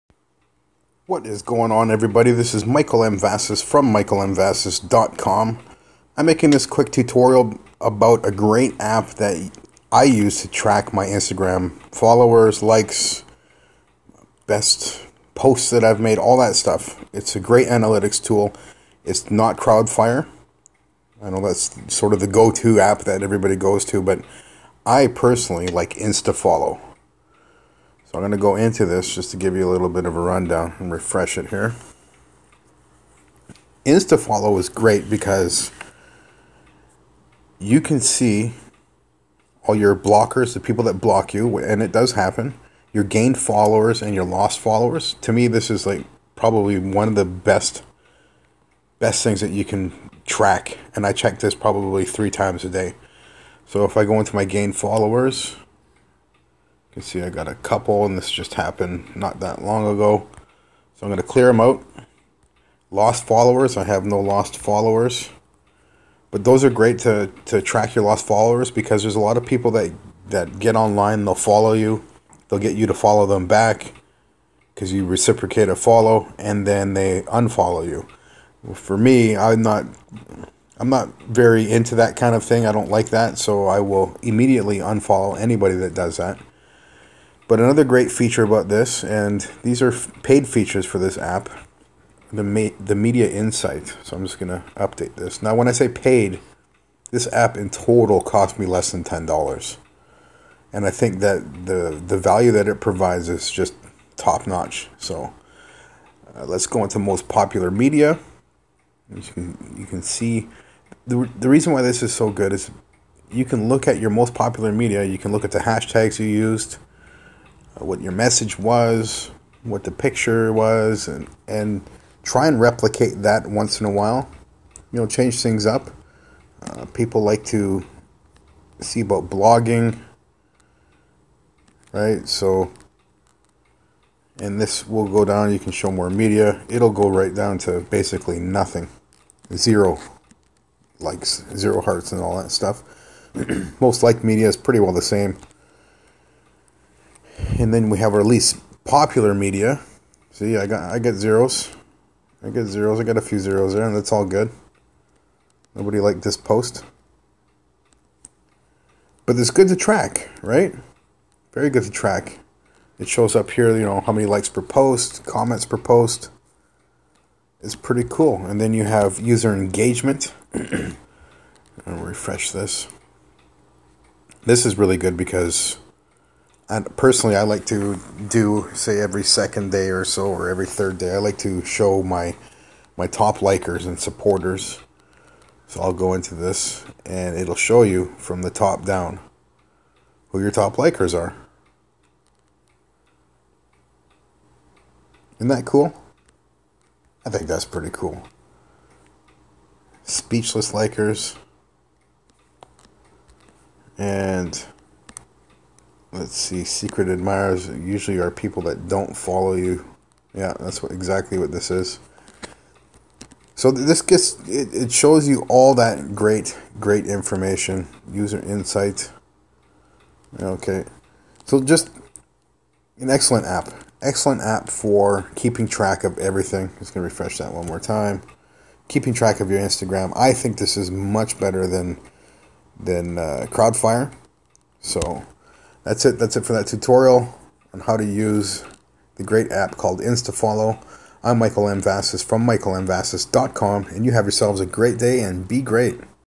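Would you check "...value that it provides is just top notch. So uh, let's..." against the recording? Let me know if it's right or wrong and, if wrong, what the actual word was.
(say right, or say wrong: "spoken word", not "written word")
right.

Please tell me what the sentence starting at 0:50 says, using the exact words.
And I check this probably three times a day.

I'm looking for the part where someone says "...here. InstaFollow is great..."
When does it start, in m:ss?
0:31.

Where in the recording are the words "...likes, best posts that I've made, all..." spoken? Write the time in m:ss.
0:12.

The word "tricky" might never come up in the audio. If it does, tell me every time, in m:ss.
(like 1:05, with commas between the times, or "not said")
not said.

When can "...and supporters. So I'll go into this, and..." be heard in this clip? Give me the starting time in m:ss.
3:03.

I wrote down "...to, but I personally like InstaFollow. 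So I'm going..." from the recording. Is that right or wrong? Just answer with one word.
right.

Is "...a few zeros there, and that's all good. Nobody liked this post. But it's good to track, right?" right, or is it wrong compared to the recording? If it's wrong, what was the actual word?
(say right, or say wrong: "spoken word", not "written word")
right.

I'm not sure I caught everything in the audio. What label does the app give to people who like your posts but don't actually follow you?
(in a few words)
Secret admirers.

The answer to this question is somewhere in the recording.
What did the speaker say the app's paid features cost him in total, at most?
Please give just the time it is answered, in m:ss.
1:38.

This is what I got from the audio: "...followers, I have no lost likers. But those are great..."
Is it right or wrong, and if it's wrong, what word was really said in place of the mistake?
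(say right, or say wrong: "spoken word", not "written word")
wrong: "followers", not "likers".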